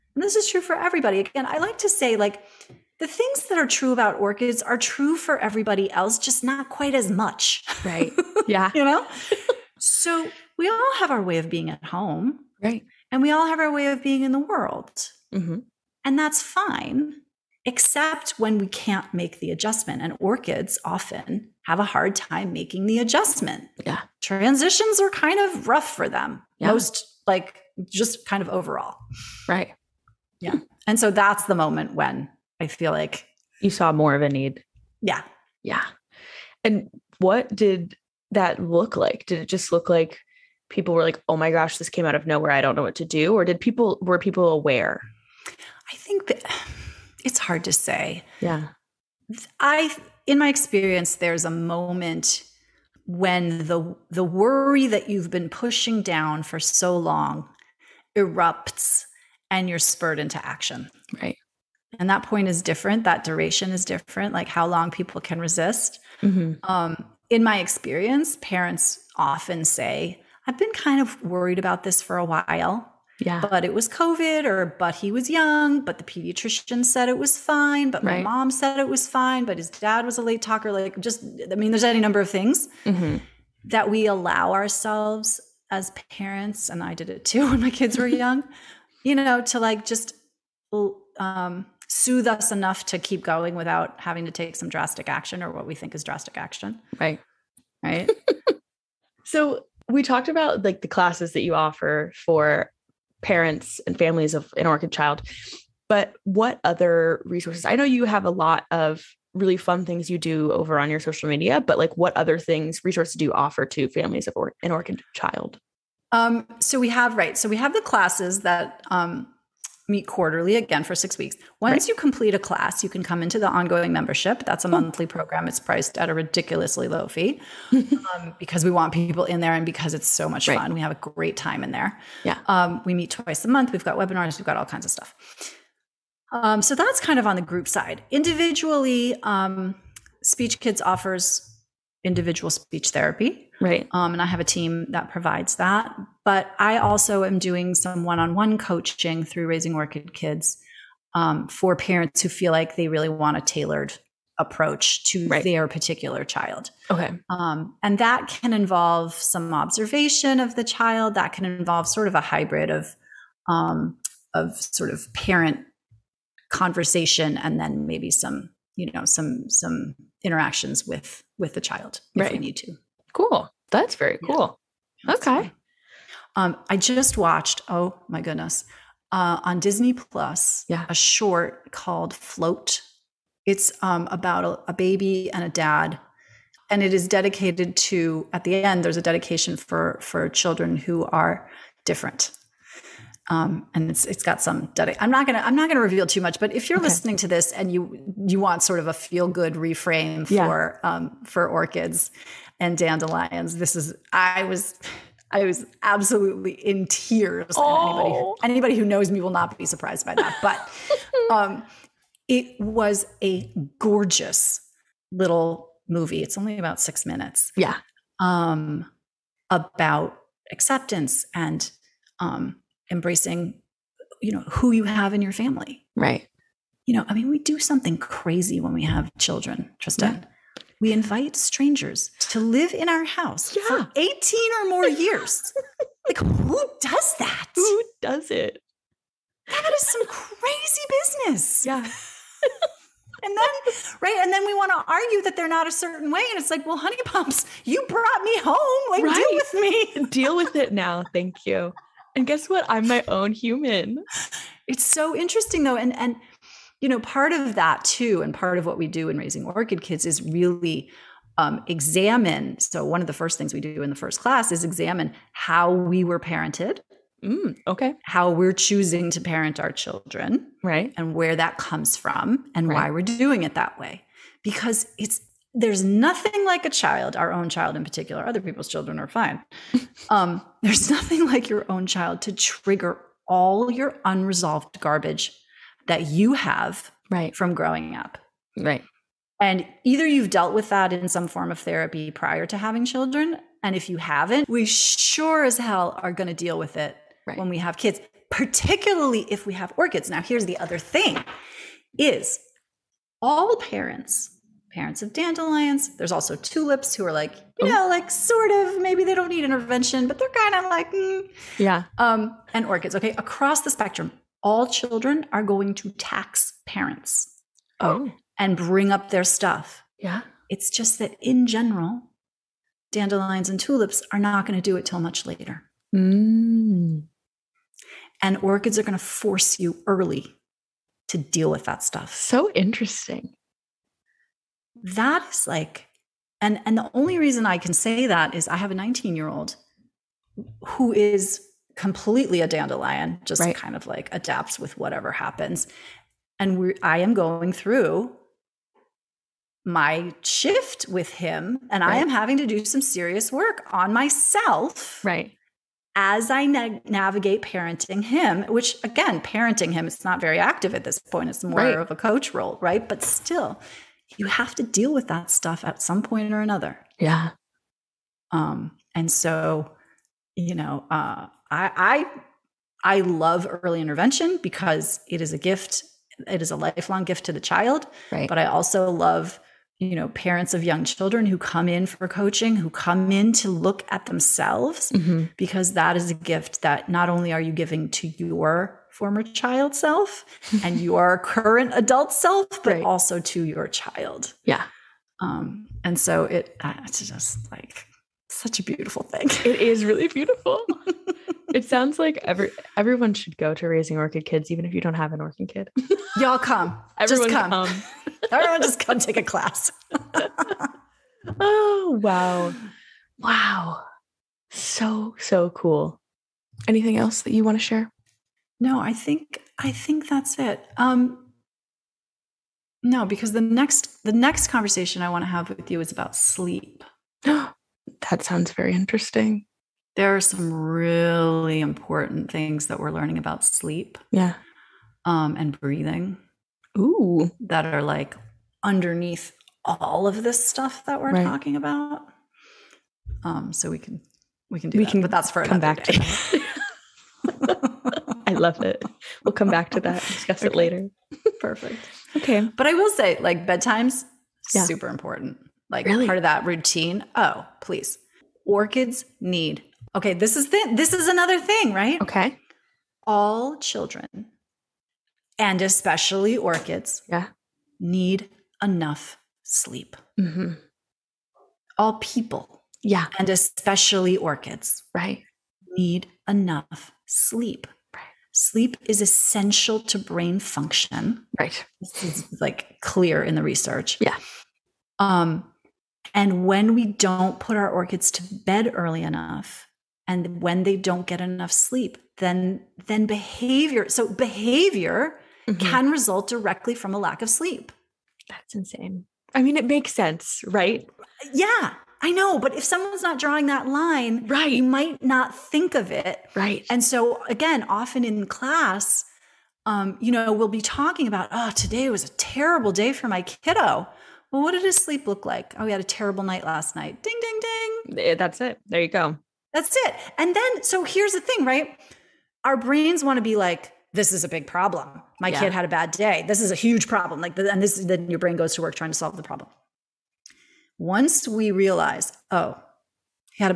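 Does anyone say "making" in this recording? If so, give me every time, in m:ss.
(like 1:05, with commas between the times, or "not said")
0:22.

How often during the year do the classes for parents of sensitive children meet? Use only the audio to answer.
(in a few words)
Quarterly.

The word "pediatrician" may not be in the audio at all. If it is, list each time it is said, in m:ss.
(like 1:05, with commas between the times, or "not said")
1:16.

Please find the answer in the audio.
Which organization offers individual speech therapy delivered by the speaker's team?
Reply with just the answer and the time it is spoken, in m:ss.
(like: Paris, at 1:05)
Speech Kids, at 2:20.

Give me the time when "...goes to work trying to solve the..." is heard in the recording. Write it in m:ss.
8:48.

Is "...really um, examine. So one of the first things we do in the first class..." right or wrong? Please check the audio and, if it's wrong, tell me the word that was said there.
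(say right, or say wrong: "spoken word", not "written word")
right.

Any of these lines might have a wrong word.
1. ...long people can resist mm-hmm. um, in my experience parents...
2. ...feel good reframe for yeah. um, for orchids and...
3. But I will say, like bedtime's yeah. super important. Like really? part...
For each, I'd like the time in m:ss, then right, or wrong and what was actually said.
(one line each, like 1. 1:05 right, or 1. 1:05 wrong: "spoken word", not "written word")
1. 1:04 right
2. 3:18 right
3. 7:32 right.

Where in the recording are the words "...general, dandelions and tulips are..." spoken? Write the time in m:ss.
5:21.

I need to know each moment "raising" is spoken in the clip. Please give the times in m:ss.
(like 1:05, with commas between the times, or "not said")
2:29, 4:19, 6:43.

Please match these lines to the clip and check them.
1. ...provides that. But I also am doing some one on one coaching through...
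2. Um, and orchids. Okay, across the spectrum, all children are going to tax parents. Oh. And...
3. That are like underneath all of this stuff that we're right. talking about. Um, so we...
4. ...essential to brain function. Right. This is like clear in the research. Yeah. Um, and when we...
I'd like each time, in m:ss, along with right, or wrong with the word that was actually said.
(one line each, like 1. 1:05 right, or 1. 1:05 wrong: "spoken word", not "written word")
1. 2:25 right
2. 5:11 right
3. 7:17 right
4. 7:59 right.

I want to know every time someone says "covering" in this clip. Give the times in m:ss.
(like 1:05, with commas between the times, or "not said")
not said.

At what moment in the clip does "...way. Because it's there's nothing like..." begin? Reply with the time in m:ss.
4:33.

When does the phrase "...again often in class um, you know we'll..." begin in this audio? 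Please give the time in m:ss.
8:27.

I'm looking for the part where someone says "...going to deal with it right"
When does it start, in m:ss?
4:56.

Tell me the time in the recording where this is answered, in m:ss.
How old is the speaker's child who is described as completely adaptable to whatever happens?
5:38.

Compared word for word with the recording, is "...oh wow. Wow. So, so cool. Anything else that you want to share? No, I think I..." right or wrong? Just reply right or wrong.
right.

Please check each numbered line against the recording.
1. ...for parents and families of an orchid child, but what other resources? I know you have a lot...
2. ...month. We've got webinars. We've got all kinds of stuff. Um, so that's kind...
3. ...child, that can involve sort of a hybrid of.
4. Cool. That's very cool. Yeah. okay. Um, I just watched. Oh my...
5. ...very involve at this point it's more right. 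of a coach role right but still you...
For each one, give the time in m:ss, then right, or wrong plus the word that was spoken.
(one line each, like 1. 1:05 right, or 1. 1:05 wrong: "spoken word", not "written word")
1. 1:42 right
2. 2:13 right
3. 2:40 right
4. 2:53 right
5. 6:00 wrong: "active", not "involve".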